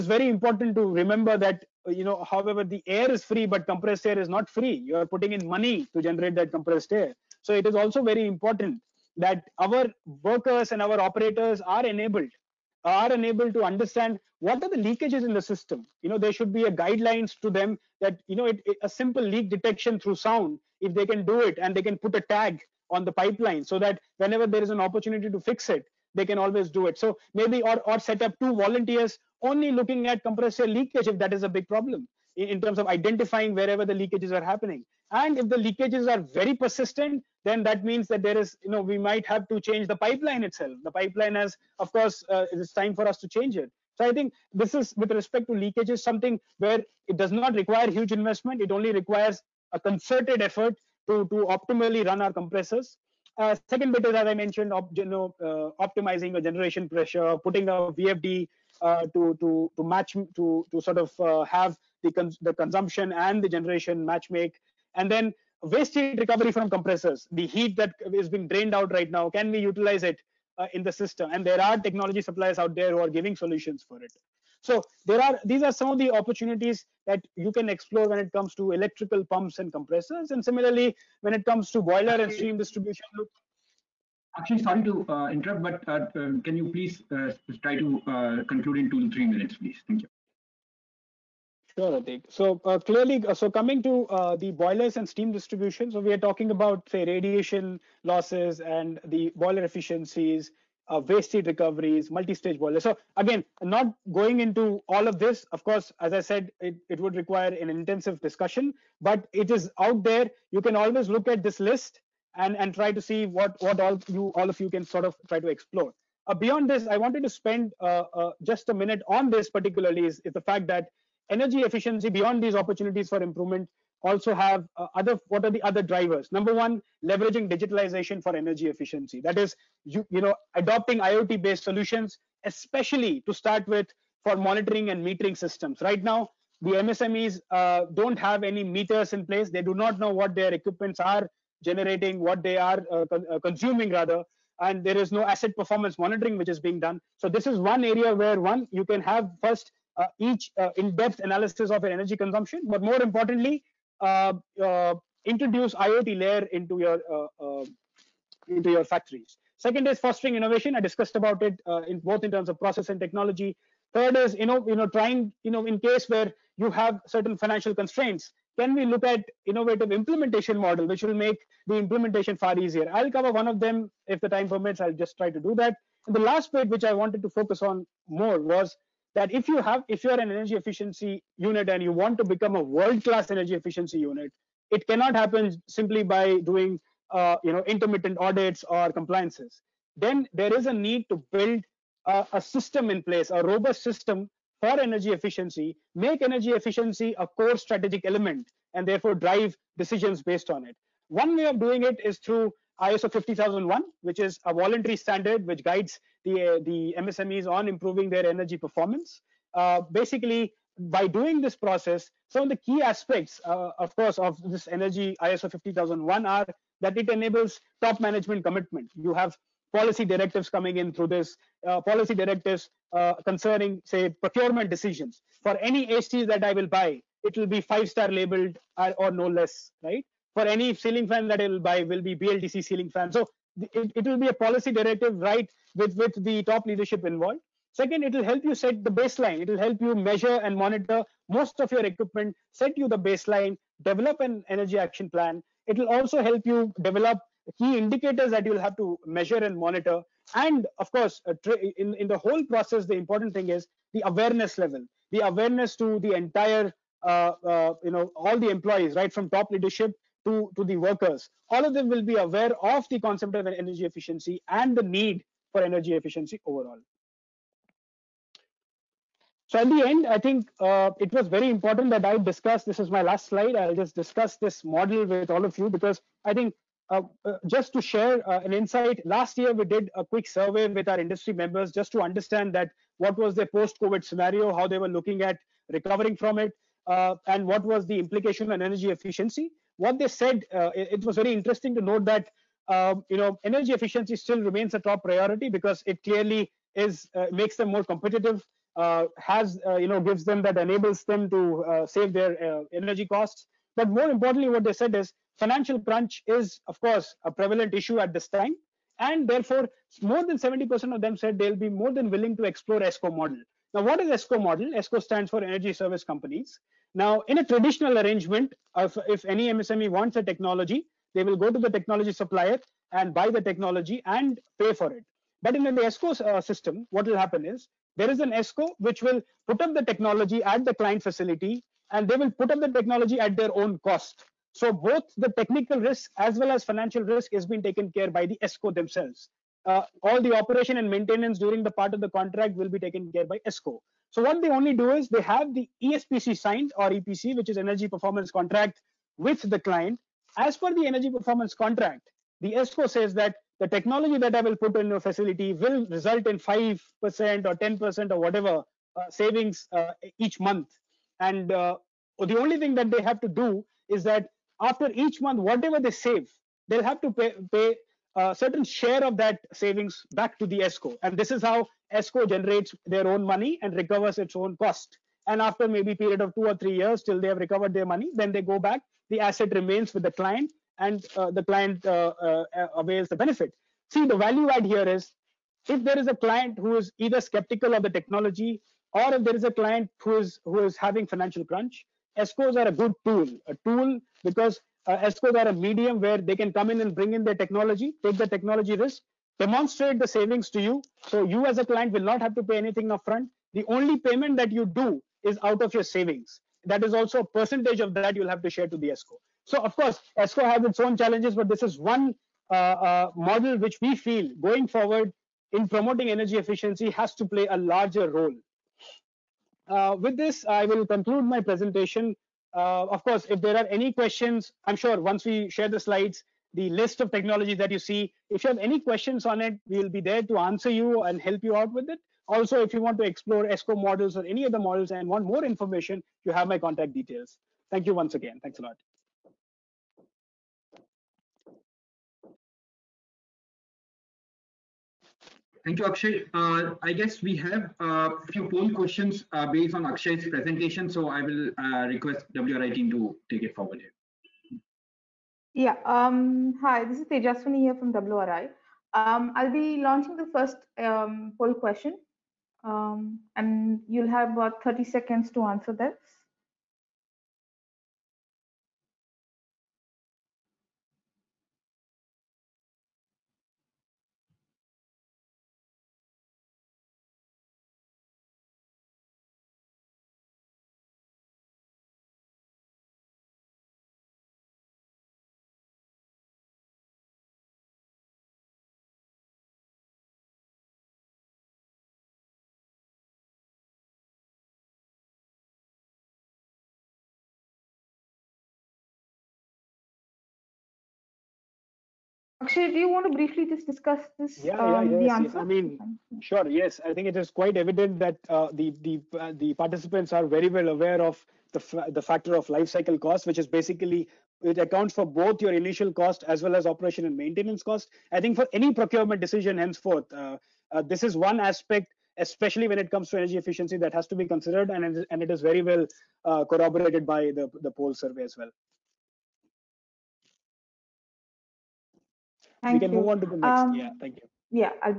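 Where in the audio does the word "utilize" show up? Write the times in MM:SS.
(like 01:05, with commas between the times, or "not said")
01:09.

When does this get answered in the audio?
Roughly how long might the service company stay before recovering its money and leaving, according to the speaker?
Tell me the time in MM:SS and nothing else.
06:16.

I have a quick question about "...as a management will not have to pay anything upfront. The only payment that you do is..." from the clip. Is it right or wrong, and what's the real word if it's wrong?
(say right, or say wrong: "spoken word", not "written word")
wrong: "client", not "management".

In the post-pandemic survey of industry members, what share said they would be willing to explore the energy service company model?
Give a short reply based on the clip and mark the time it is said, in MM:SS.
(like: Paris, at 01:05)
More than 70%, at 05:10.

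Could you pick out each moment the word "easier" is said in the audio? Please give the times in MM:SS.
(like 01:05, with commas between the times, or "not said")
02:52.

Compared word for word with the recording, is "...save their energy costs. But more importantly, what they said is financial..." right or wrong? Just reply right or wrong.
right.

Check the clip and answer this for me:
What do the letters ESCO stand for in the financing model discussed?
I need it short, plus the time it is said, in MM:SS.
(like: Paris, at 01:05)
Energy Service Companies, at 05:15.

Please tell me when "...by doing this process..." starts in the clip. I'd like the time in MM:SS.
03:30.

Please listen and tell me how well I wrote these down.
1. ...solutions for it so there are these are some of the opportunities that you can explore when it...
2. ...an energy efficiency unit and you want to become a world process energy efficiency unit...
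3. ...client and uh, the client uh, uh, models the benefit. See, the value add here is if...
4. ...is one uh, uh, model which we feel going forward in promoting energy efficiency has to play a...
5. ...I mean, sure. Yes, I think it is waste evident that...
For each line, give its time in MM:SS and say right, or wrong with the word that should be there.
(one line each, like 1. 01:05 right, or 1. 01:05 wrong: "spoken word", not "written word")
1. 01:13 right
2. 03:00 wrong: "class", not "process"
3. 06:20 wrong: "avails", not "models"
4. 06:51 right
5. 08:25 wrong: "quite", not "waste".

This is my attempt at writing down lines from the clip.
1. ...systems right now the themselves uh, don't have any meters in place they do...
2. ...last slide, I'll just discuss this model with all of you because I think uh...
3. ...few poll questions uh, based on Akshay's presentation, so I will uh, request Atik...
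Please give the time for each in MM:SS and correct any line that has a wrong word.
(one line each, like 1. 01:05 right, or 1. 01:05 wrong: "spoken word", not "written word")
1. 02:15 wrong: "msmes", not "themselves"
2. 04:33 right
3. 07:28 wrong: "WRI", not "Atik".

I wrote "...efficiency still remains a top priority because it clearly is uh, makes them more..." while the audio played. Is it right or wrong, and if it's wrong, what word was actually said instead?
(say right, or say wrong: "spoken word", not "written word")
right.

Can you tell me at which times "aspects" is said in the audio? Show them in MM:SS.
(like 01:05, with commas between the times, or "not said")
03:32, 08:41.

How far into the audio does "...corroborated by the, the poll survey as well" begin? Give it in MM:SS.
08:46.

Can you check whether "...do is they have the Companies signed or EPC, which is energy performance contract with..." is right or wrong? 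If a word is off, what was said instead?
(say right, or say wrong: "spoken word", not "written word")
wrong: "ESPC", not "Companies".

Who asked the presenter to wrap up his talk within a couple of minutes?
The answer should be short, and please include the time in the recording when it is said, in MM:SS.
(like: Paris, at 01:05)
Atik, at 01:32.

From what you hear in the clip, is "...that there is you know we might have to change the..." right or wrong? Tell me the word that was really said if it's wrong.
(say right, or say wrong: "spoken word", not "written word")
right.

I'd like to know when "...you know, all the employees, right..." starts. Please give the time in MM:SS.
04:17.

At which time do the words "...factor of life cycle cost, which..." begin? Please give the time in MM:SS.
08:32.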